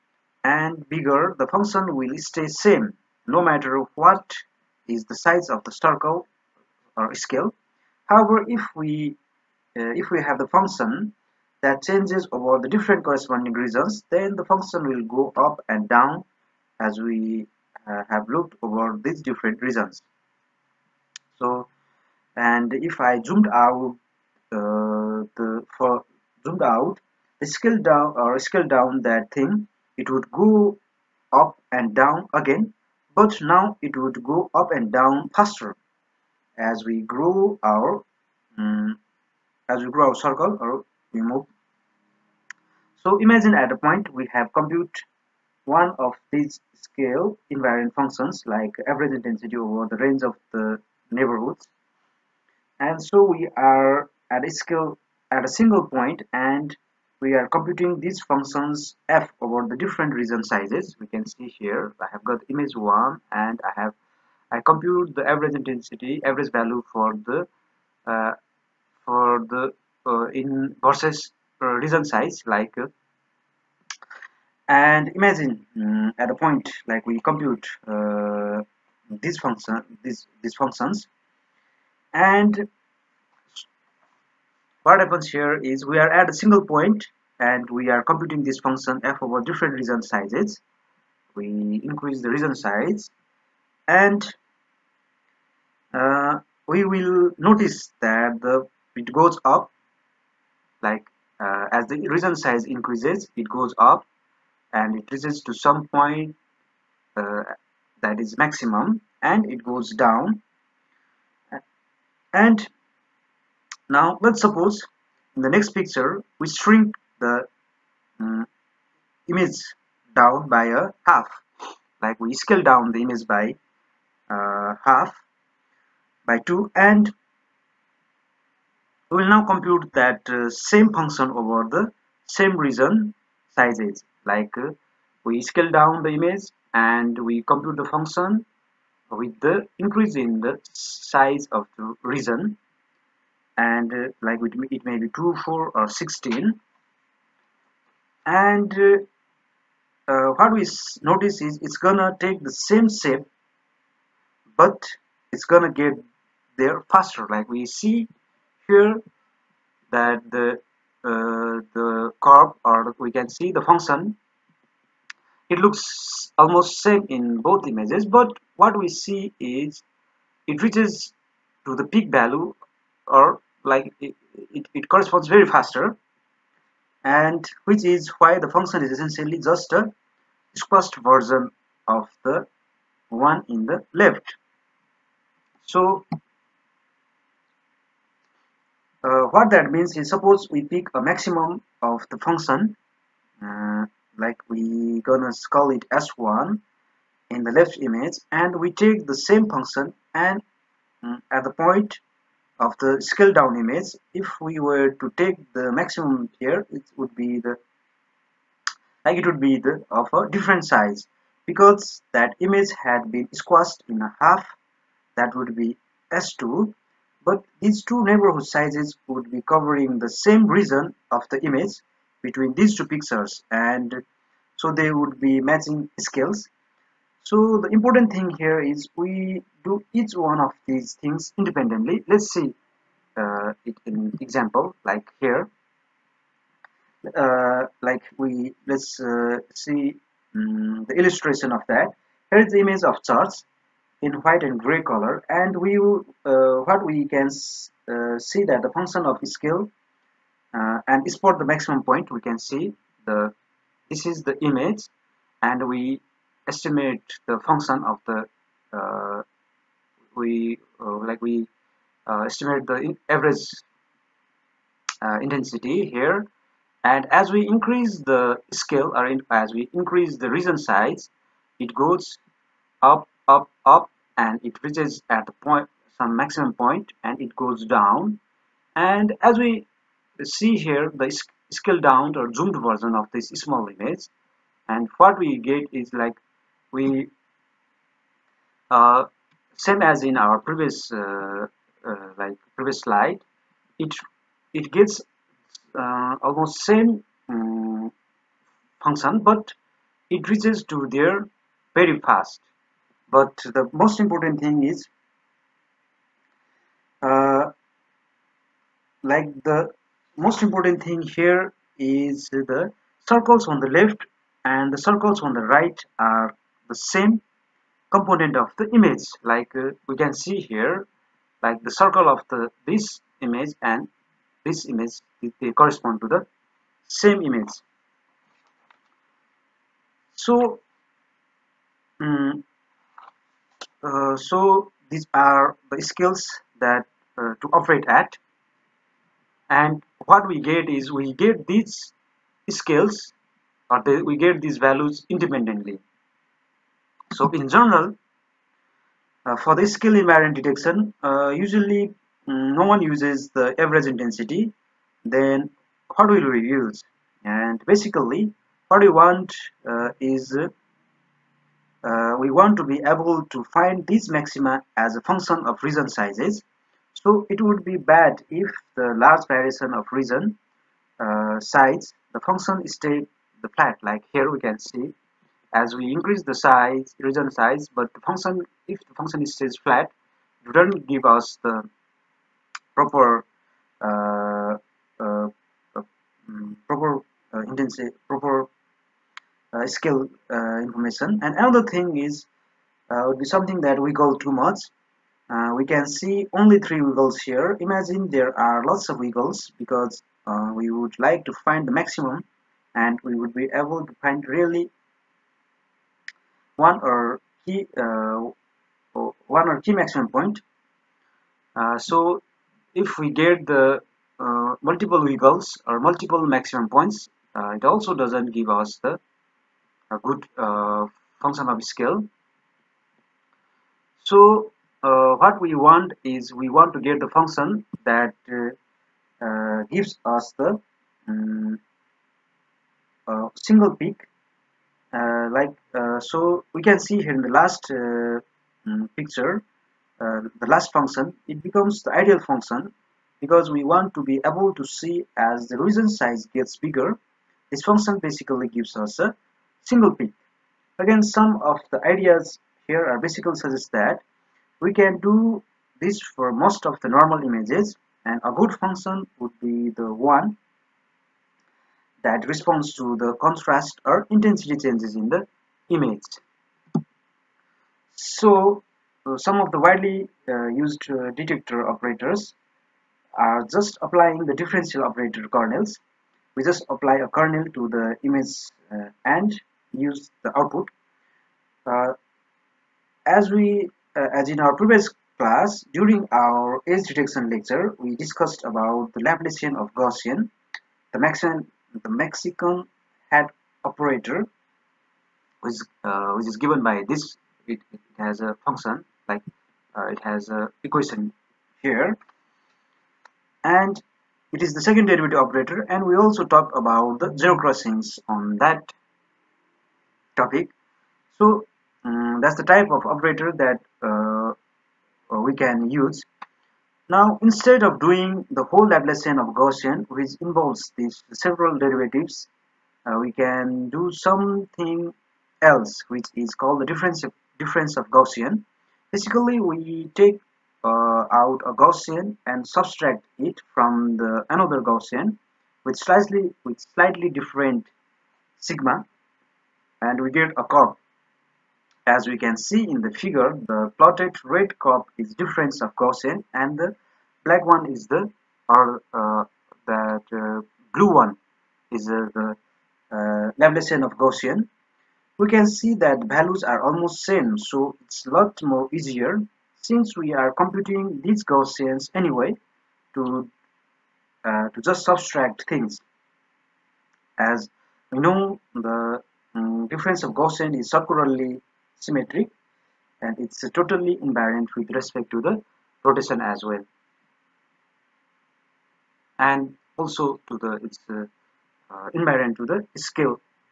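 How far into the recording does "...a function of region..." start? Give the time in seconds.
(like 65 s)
364 s.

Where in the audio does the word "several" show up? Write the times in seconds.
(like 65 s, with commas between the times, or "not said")
521 s.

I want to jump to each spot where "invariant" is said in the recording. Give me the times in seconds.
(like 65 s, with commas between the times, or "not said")
47 s, 350 s, 574 s, 581 s.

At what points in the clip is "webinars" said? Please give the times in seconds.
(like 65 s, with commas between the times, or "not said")
not said.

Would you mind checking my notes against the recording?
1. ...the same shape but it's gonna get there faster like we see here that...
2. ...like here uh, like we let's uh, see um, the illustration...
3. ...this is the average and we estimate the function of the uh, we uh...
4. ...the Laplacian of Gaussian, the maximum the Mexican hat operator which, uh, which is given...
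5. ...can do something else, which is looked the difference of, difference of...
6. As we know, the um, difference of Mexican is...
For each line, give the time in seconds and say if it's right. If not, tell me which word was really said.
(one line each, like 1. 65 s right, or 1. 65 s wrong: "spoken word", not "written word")
1. 152 s right
2. 234 s right
3. 253 s wrong: "image", not "average"
4. 488 s right
5. 523 s wrong: "called", not "looked"
6. 567 s wrong: "Gaussian", not "Mexican".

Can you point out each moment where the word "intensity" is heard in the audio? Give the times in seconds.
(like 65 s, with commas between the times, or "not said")
49 s, 65 s, 265 s, 353 s, 387 s, 464 s.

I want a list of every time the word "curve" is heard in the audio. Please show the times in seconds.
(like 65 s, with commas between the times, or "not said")
162 s, 540 s, 544 s.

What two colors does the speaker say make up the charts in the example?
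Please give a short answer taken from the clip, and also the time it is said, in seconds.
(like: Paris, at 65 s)
White and gray, at 244 s.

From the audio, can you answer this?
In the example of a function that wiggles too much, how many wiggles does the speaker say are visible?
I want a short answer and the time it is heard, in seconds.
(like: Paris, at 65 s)
3, at 396 s.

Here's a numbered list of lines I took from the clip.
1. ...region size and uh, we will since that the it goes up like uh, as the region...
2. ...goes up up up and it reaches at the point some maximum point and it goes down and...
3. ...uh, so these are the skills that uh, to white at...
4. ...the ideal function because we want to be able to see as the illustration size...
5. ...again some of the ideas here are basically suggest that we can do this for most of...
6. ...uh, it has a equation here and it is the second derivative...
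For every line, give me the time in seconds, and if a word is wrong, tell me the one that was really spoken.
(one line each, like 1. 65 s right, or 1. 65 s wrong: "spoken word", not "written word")
1. 92 s wrong: "notice", not "since"
2. 271 s right
3. 333 s wrong: "operate", not "white"
4. 441 s wrong: "region", not "illustration"
5. 450 s right
6. 499 s right.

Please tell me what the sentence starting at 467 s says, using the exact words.
So uh, some of the widely uh, used uh, detector operators are just applying the differential operator kernels.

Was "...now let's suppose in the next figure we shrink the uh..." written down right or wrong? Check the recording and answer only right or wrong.
wrong.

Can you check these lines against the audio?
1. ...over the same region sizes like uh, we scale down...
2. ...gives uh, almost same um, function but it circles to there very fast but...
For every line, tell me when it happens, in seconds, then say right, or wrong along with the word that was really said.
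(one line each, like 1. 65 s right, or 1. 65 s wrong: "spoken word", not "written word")
1. 131 s right
2. 294 s wrong: "reaches", not "circles".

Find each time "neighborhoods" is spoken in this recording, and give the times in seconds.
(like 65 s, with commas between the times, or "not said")
51 s, 218 s.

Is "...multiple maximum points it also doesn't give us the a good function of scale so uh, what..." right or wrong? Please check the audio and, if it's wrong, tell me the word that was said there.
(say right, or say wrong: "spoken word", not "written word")
right.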